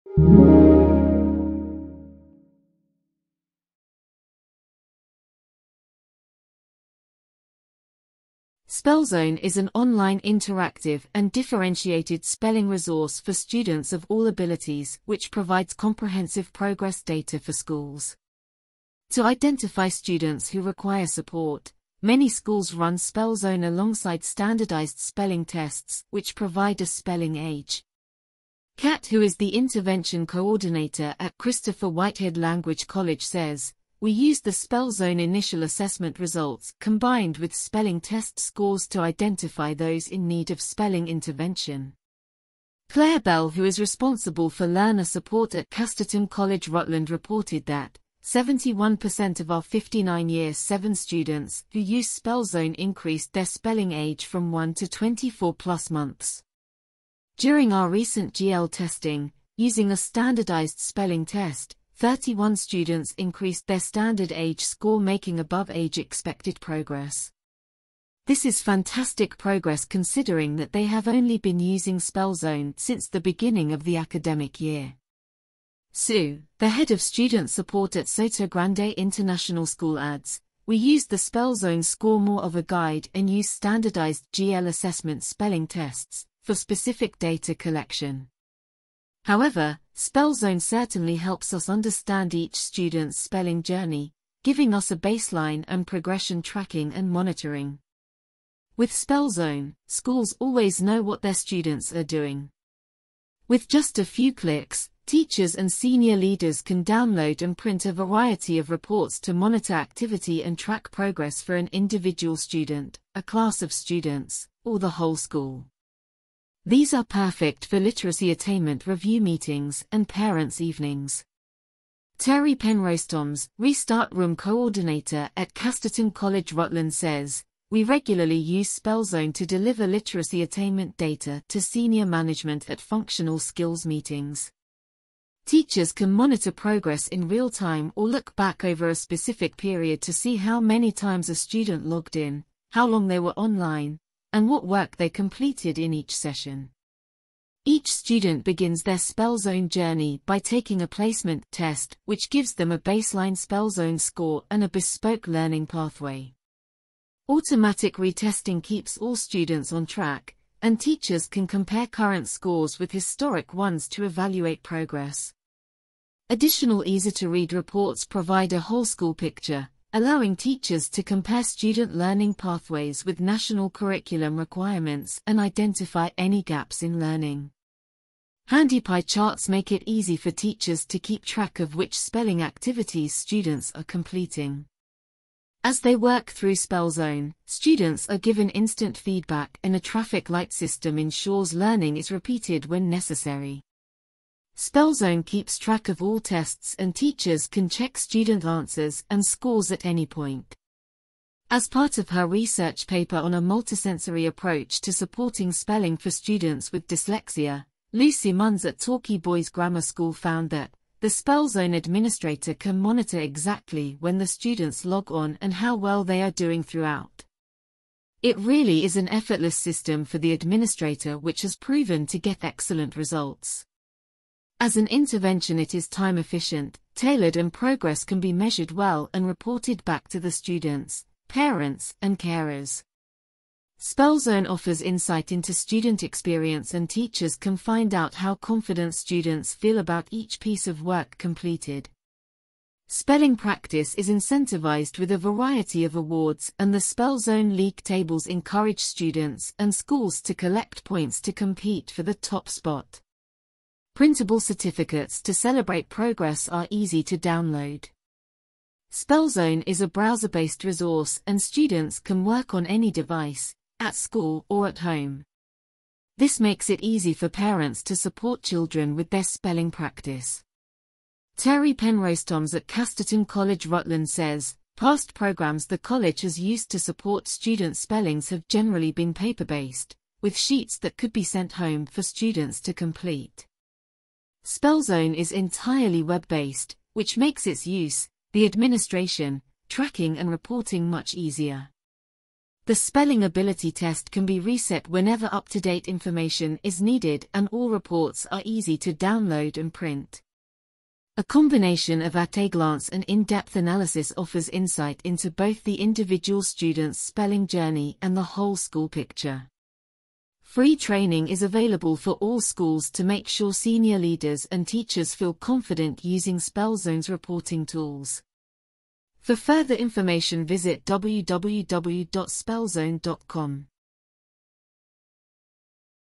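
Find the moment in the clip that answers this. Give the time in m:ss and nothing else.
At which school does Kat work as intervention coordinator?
0:31.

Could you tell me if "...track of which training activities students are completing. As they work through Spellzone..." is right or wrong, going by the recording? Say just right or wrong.
wrong.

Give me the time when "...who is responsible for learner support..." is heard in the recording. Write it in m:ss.
0:43.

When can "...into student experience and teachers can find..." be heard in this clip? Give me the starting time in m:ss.
3:55.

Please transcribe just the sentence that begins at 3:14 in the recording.
Spellzone keeps track of all tests and teachers can check student answers and scores at any point.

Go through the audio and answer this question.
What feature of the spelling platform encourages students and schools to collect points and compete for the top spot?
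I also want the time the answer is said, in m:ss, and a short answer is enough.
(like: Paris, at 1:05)
Spellzone League tables, at 4:06.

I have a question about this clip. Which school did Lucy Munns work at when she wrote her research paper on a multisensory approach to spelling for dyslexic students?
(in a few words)
Torquay Boys Grammar School.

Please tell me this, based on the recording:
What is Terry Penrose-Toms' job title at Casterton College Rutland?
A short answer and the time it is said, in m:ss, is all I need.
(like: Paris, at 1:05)
Restart Room Coordinator, at 2:03.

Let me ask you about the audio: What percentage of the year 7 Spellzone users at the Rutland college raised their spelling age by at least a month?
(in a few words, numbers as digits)
71%.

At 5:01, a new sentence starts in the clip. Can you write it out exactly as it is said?
A combination of at-a-glance and in-depth analysis offers insight into both the individual student's spelling journey and the whole school picture.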